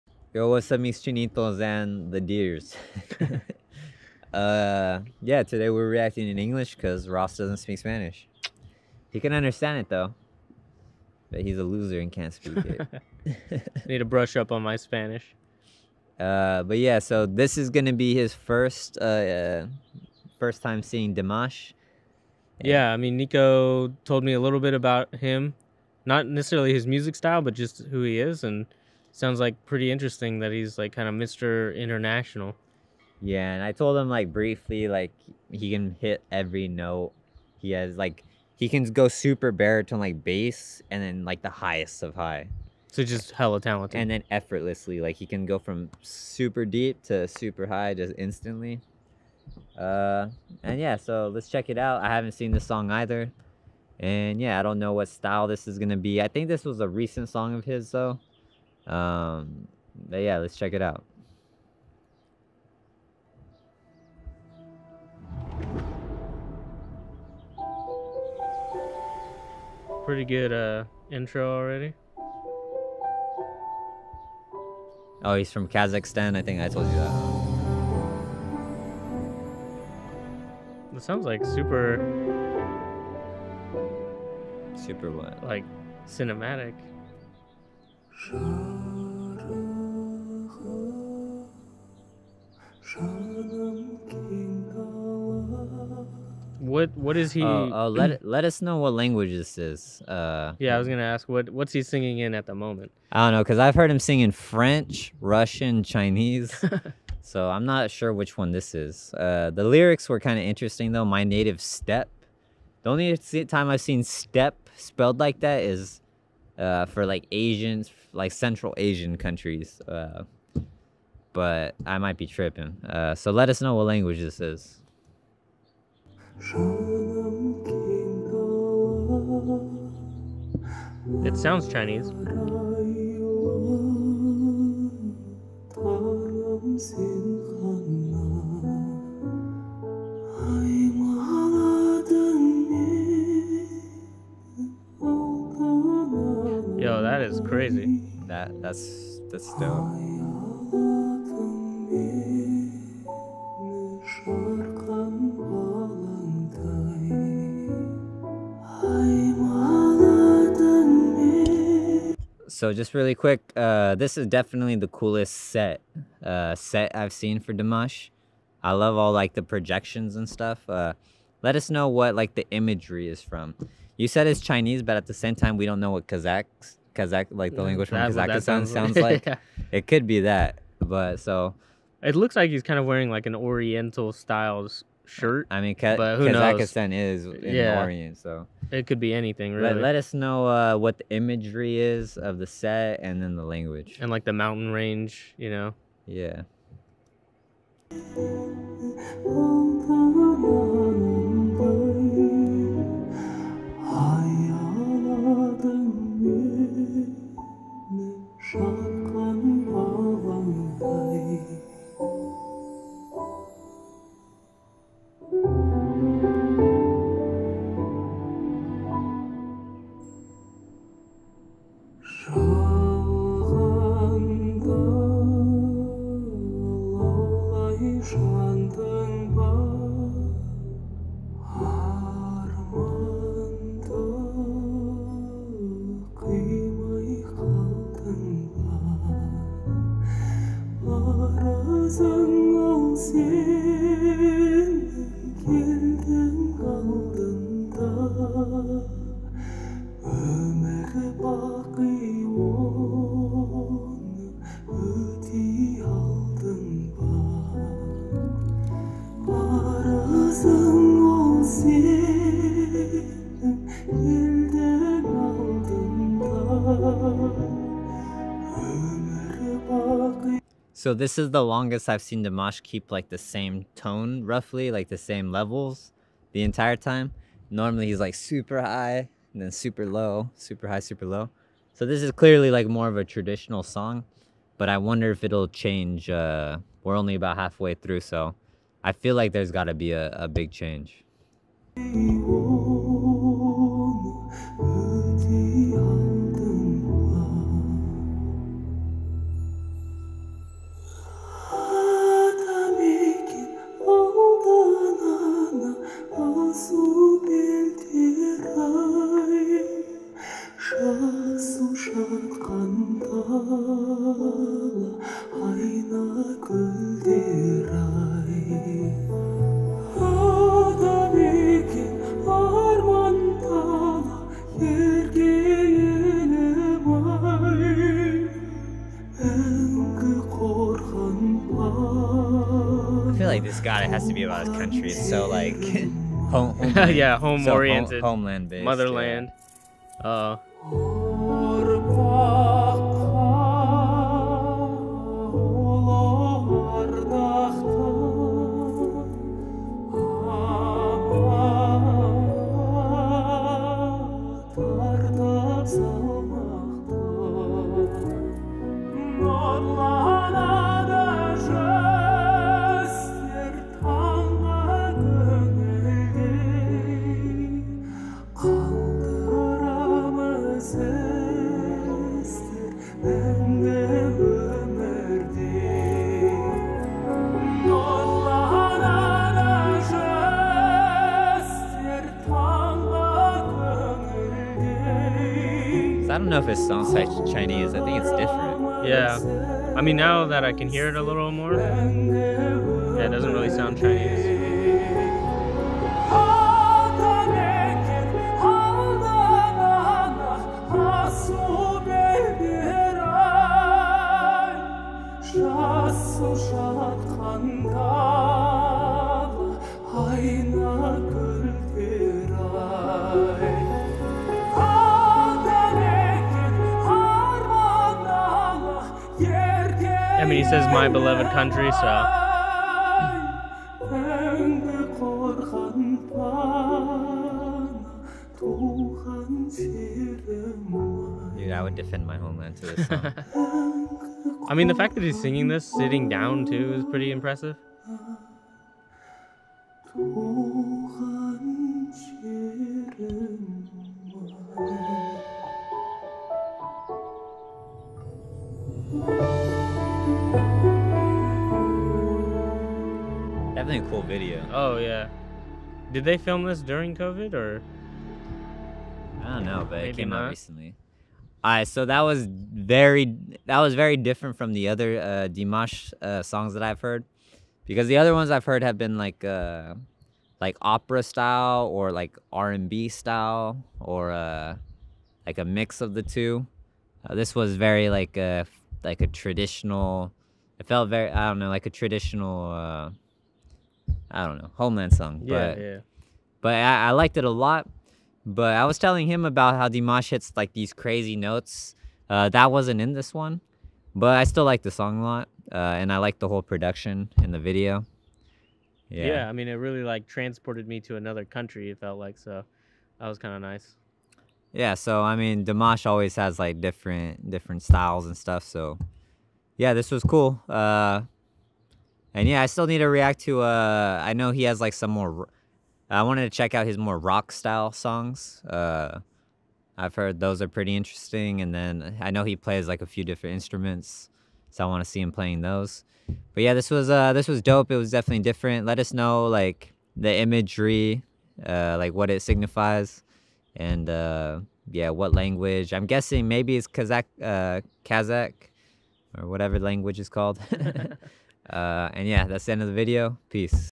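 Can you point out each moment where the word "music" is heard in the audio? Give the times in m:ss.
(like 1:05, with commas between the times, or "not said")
0:26.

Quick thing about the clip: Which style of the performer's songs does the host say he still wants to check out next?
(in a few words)
rock.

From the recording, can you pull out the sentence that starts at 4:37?
Normally he's like super high and then super low, super high, super low.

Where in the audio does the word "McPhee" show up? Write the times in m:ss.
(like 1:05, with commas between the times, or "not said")
not said.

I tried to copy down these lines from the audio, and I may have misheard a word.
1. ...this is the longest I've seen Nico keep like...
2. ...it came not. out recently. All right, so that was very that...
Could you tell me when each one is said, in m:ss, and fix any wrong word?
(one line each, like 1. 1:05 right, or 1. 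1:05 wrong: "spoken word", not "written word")
1. 4:30 wrong: "Dimash", not "Nico"
2. 7:39 right.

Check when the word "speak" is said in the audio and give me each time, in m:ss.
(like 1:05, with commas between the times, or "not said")
0:07, 0:12.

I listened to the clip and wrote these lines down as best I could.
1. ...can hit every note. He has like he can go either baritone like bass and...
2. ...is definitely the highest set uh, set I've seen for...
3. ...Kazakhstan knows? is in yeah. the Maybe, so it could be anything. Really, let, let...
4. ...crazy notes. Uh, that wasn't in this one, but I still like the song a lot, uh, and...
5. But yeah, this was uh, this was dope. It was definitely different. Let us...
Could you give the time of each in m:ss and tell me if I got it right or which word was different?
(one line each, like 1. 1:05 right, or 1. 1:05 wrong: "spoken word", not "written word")
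1. 0:35 wrong: "super", not "either"
2. 2:44 wrong: "coolest", not "highest"
3. 3:05 wrong: "Orient", not "Maybe"
4. 8:10 right
5. 8:46 right.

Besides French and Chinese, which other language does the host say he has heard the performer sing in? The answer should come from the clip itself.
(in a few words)
Russian.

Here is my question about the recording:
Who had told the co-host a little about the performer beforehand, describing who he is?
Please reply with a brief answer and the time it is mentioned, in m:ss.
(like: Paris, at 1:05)
Nico, at 0:23.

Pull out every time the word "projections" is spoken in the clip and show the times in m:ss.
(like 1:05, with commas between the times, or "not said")
2:49.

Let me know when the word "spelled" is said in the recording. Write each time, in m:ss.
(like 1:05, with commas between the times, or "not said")
1:54.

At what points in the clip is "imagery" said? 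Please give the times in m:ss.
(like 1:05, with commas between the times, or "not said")
2:52, 3:11, 8:50.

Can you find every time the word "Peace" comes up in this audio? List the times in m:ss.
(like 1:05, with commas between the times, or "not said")
9:03.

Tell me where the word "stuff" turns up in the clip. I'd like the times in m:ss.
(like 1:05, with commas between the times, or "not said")
2:50, 8:28.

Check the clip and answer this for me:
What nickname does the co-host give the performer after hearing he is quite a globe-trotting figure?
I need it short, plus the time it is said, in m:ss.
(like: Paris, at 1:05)
Mr. International, at 0:31.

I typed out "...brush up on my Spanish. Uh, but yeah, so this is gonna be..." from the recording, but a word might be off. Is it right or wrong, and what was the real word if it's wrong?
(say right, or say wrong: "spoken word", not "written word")
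right.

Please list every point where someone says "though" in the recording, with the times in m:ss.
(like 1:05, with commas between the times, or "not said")
0:09, 0:57, 1:50.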